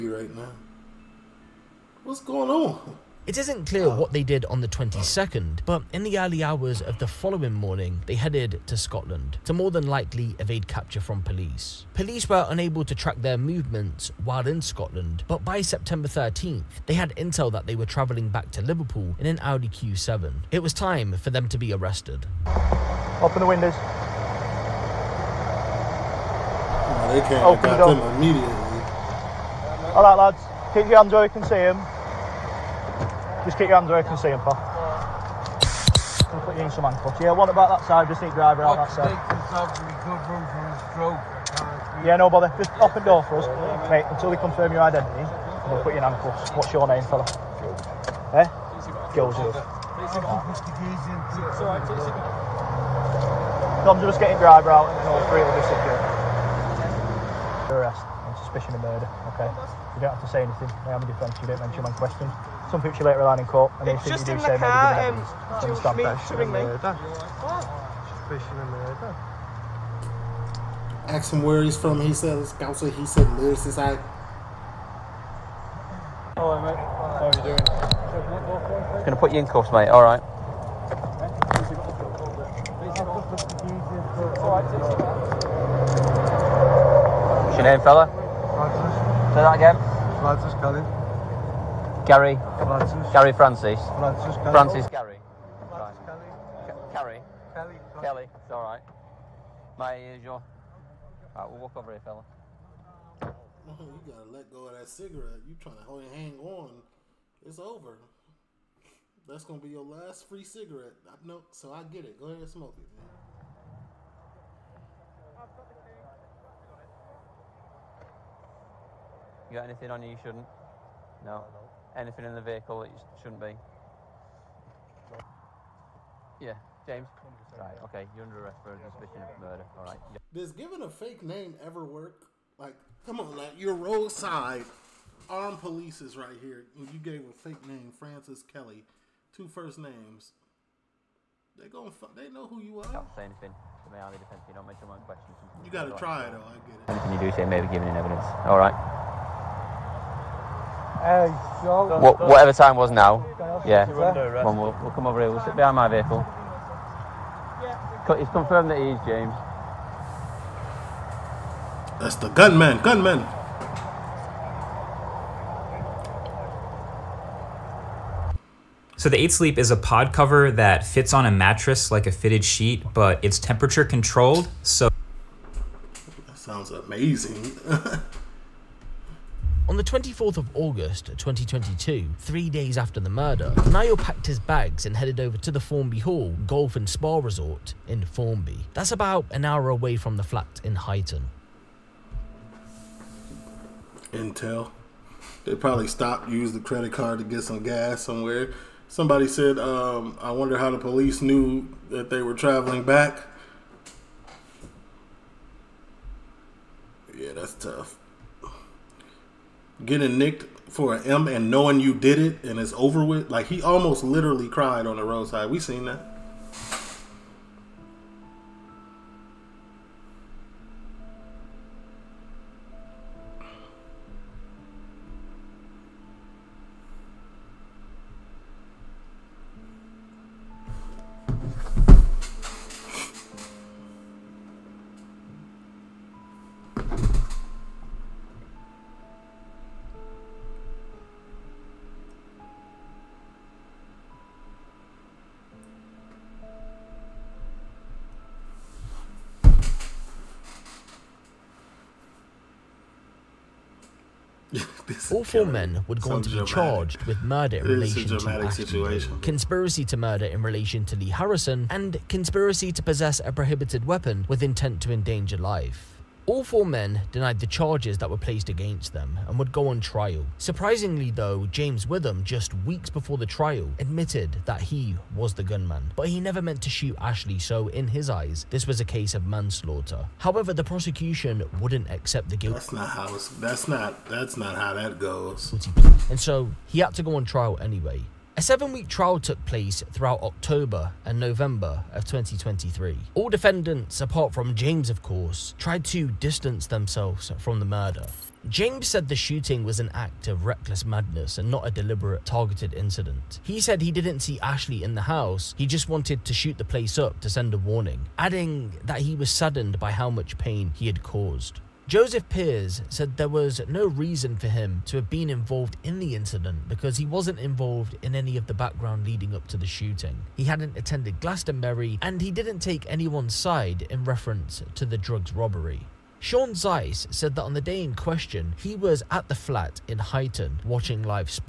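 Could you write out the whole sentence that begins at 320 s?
He hadn't attended Glastonbury and he didn't take anyone's side in reference to the drugs robbery.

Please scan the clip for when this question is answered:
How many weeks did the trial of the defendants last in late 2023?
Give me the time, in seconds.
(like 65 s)
288 s.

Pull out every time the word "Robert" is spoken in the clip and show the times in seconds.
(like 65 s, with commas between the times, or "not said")
not said.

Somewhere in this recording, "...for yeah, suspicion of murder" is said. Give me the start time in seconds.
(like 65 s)
128 s.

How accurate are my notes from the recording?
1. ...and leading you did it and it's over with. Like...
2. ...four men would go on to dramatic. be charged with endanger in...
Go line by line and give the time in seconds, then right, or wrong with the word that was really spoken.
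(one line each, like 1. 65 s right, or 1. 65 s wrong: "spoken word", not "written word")
1. 211 s wrong: "knowing", not "leading"
2. 255 s wrong: "murder", not "endanger".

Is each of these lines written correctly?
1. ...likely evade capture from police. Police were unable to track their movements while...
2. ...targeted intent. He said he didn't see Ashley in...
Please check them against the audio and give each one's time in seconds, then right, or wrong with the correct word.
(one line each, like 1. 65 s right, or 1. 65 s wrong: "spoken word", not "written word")
1. 9 s right
2. 302 s wrong: "incident", not "intent".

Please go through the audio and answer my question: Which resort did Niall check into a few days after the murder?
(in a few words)
Formby Hall Golf and Spa Resort.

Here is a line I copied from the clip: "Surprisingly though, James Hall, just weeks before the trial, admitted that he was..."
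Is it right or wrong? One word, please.
wrong.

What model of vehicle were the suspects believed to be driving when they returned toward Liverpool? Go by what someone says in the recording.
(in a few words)
Audi Q7.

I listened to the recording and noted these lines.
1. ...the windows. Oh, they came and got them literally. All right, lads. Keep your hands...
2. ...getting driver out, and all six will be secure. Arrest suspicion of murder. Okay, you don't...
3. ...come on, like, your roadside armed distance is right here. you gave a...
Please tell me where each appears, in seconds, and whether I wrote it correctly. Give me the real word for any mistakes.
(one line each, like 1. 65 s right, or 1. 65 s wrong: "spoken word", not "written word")
1. 23 s wrong: "immediately", not "literally"
2. 54 s wrong: "three", not "six"
3. 133 s wrong: "police", not "distance".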